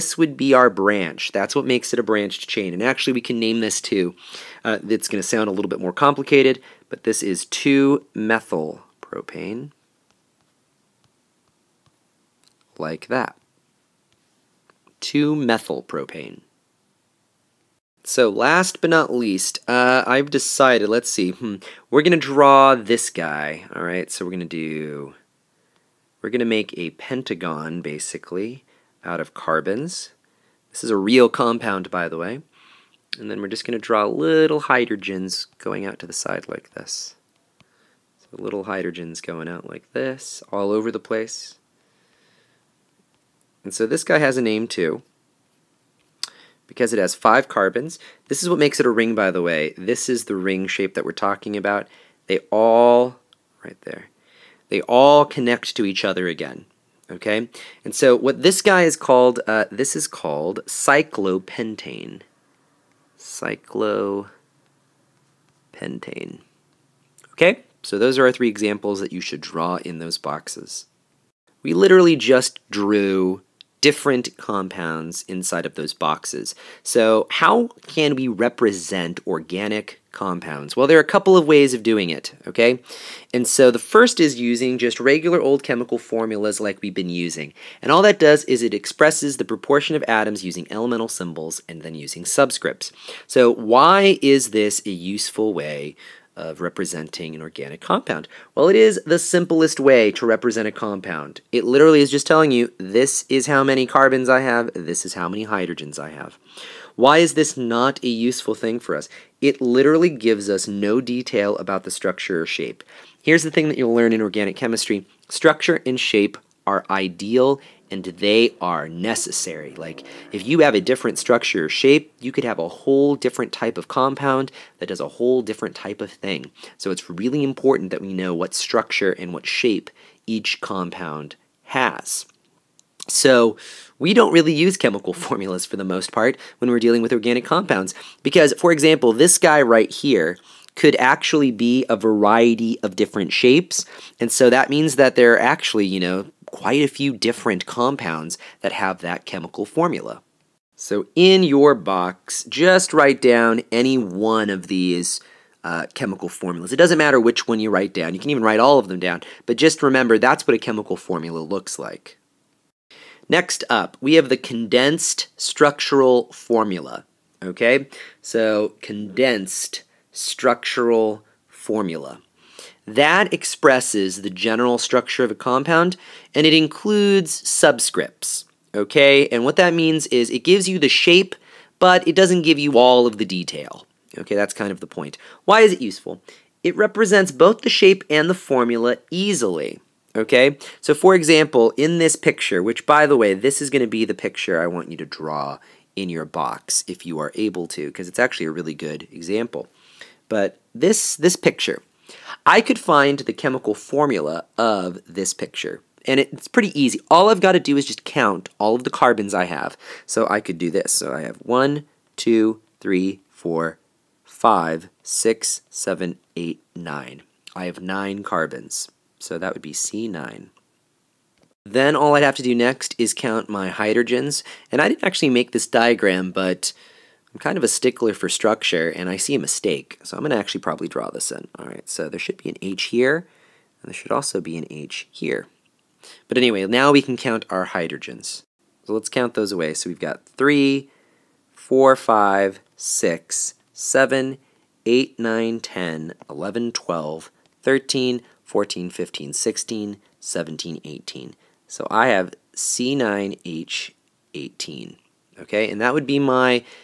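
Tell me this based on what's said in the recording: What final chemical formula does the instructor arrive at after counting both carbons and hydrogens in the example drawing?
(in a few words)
C9H18.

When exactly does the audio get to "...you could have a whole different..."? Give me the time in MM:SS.
02:02.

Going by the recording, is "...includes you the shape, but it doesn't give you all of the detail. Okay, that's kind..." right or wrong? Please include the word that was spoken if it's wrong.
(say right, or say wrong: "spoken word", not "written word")
wrong: "gives", not "includes".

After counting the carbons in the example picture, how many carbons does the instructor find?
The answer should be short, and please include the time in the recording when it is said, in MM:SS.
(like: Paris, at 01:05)
9, at 03:37.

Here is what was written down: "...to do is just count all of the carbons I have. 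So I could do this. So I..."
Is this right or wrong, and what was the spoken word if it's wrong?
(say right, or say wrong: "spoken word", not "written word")
right.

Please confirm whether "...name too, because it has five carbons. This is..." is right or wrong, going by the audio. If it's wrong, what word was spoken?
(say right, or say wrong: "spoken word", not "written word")
right.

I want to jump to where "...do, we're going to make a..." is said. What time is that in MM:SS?
00:24.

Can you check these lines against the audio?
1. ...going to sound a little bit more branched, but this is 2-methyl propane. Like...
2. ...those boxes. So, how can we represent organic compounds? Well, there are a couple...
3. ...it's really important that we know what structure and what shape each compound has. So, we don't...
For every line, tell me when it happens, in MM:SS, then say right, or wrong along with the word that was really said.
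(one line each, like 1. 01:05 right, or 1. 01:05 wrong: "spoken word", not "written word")
1. 00:05 wrong: "complicated", not "branched"
2. 01:15 right
3. 02:06 right.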